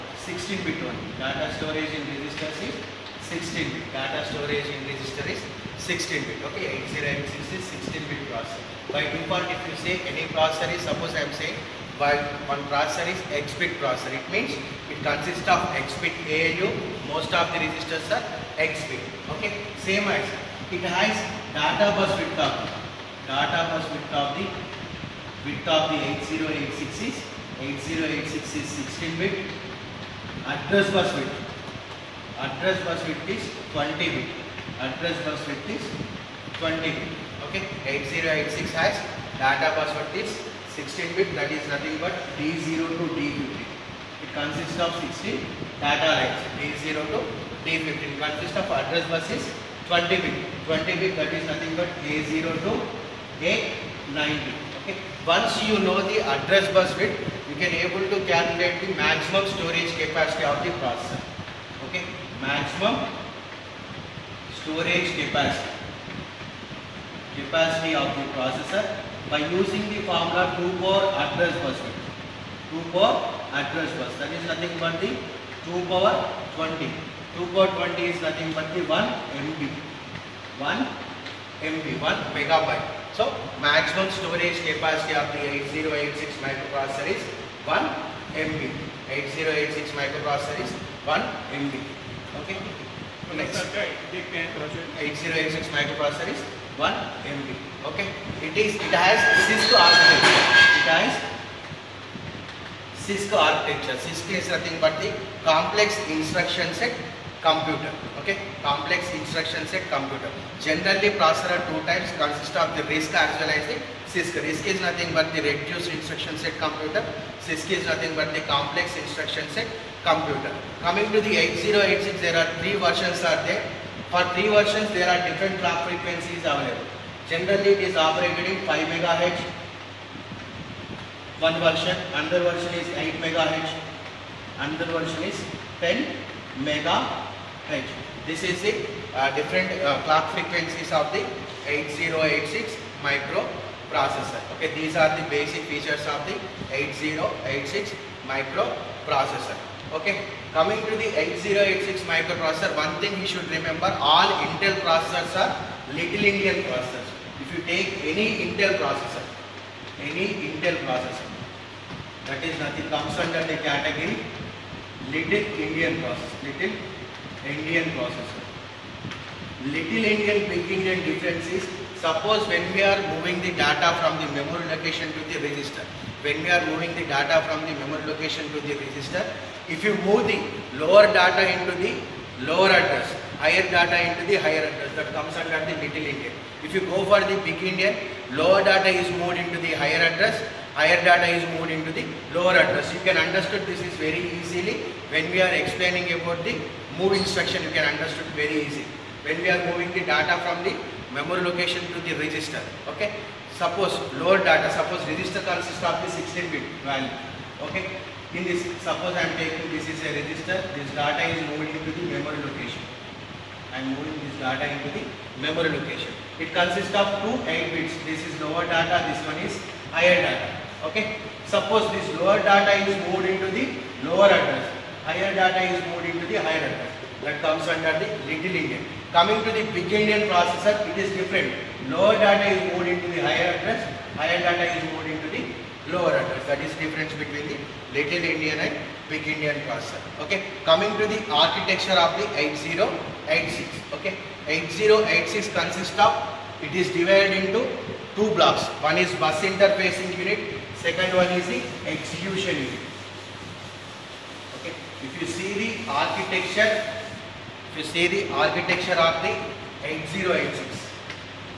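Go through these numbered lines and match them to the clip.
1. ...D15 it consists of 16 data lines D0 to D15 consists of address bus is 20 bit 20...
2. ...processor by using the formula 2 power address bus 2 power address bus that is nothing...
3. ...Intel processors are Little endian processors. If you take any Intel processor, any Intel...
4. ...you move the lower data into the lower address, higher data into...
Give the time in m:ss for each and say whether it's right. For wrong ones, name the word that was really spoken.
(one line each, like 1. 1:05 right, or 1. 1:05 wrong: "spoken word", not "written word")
1. 0:43 right
2. 1:08 right
3. 2:34 right
4. 2:59 right.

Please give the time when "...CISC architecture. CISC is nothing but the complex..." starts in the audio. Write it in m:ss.
1:43.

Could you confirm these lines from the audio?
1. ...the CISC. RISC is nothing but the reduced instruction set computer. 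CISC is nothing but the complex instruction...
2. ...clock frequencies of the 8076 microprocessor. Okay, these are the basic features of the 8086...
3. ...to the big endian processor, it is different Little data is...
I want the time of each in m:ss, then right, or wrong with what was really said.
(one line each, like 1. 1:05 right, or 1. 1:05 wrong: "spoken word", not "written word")
1. 1:53 right
2. 2:20 wrong: "8086", not "8076"
3. 3:49 wrong: "Lower", not "Little".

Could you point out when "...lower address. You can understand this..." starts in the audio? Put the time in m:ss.
3:12.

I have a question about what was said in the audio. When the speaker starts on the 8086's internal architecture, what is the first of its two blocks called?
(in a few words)
Bus interfacing unit.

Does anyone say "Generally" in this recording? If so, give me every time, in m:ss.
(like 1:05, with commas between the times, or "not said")
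1:50, 2:07.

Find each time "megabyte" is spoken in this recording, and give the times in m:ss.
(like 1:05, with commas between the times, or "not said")
1:22.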